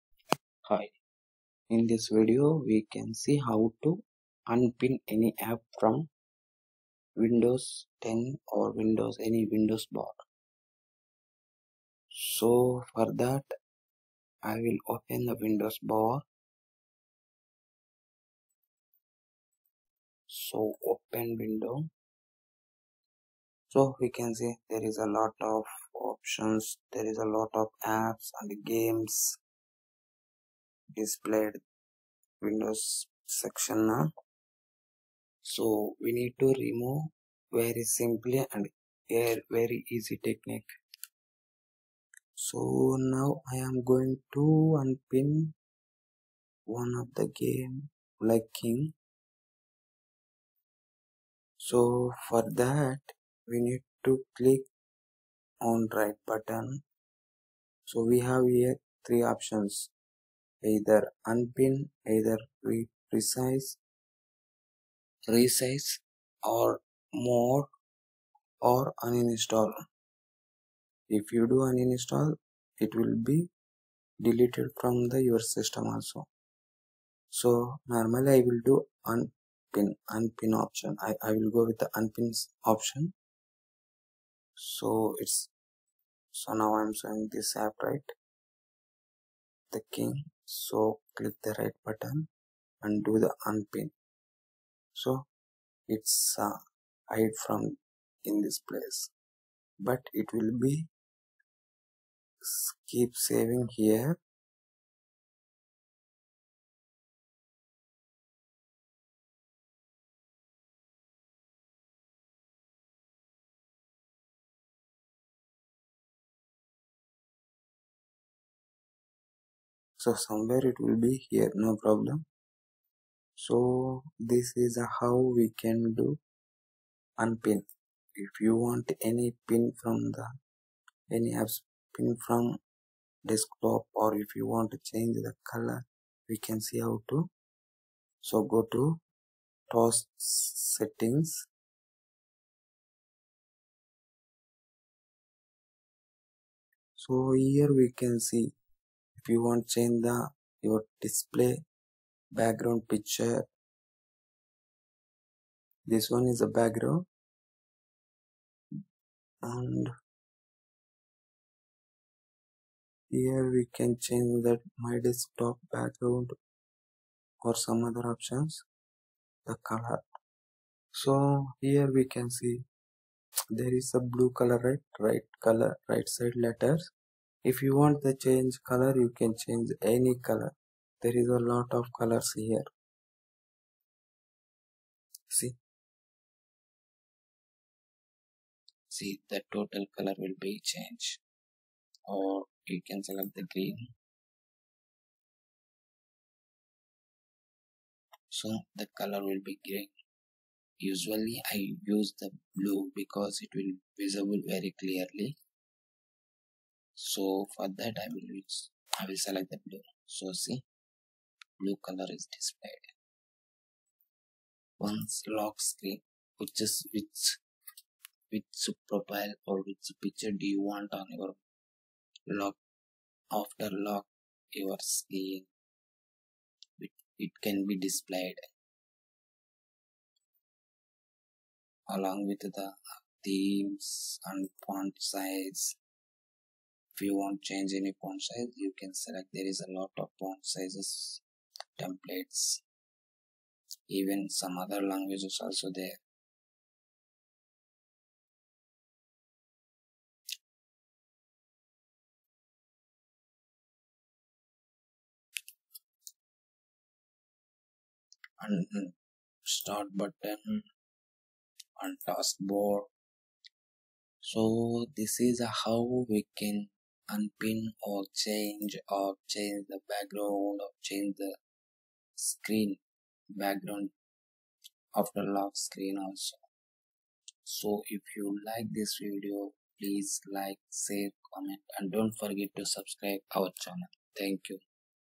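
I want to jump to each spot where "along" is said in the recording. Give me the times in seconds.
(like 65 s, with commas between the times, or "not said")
231 s.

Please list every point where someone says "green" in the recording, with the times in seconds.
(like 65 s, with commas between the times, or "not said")
193 s, 199 s.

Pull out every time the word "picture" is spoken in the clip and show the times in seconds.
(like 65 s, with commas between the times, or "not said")
152 s, 220 s.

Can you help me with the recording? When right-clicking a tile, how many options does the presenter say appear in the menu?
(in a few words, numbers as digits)
3.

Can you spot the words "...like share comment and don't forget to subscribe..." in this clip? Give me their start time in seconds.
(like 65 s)
280 s.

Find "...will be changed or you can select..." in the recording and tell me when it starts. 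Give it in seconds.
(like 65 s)
190 s.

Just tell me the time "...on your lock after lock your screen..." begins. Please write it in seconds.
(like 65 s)
220 s.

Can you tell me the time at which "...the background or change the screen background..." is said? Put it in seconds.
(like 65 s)
269 s.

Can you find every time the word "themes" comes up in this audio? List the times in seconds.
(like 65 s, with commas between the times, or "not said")
233 s.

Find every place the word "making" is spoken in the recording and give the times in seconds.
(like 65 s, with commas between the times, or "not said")
not said.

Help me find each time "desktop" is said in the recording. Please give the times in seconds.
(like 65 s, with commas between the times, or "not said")
133 s, 165 s.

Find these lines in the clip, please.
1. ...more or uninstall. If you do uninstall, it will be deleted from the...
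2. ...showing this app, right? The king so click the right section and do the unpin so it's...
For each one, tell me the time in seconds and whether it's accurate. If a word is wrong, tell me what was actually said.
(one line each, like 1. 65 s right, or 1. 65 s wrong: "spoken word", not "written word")
1. 67 s right
2. 86 s wrong: "button", not "section".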